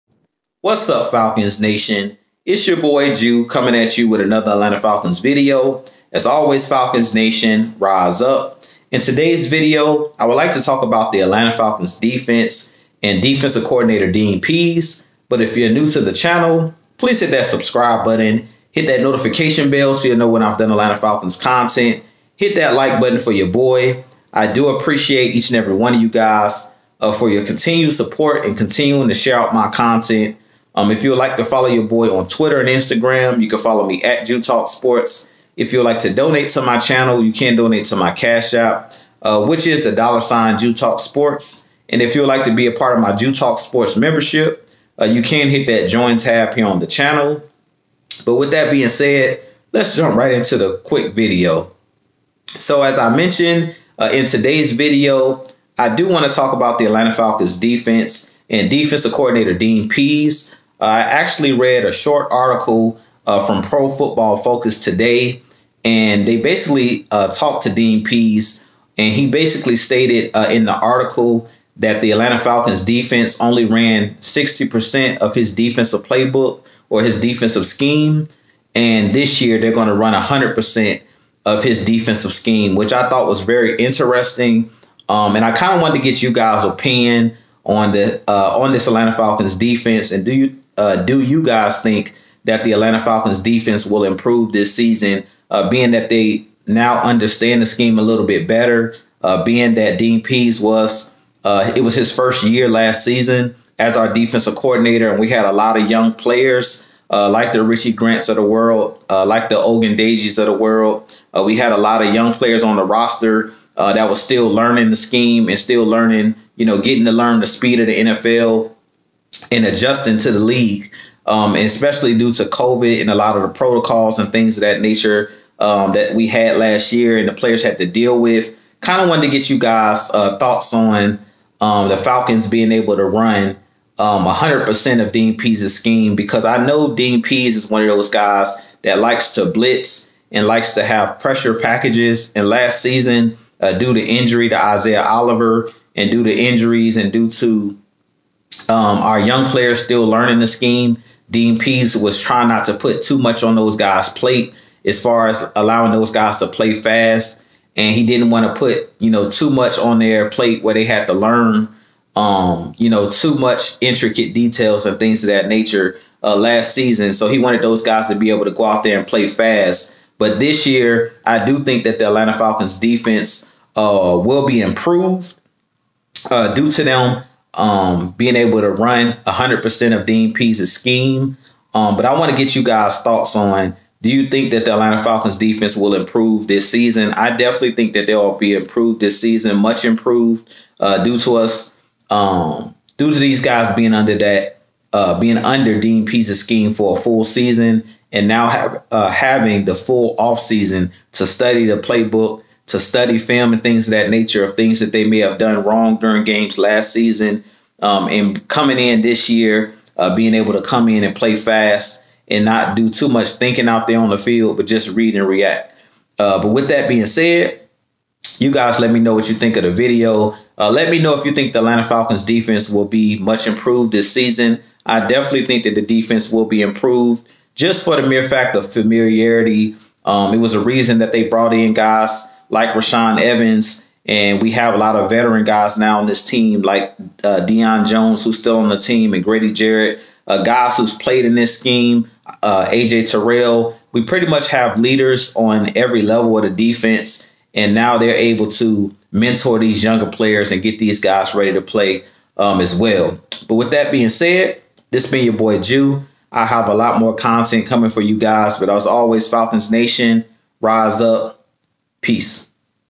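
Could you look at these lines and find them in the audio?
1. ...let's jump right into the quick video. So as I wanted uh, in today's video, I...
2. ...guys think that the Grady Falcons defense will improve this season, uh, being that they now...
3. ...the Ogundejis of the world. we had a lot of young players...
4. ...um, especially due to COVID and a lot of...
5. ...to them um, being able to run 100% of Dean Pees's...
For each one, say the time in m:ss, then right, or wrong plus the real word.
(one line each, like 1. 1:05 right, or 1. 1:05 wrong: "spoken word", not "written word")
1. 0:49 wrong: "mentioned", not "wanted"
2. 1:31 wrong: "Atlanta", not "Grady"
3. 1:49 right
4. 2:01 right
5. 2:56 right.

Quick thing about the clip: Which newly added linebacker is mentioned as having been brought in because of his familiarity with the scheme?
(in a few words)
Rashaan Evans.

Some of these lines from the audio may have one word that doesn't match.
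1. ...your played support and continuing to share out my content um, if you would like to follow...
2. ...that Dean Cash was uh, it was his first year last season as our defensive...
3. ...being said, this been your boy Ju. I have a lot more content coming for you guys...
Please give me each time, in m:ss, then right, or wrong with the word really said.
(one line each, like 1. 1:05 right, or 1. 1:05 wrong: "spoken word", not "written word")
1. 0:27 wrong: "continued", not "played"
2. 1:39 wrong: "Pees", not "Cash"
3. 4:13 right.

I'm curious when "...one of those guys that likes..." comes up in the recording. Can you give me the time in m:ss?
2:17.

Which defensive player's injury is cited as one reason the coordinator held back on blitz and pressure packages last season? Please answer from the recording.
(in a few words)
Isaiah Oliver.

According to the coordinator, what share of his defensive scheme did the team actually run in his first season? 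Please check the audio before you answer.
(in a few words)
60%.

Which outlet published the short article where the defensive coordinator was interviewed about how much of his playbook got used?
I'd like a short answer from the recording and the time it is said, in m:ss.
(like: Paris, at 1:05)
Pro Football Focus, at 1:03.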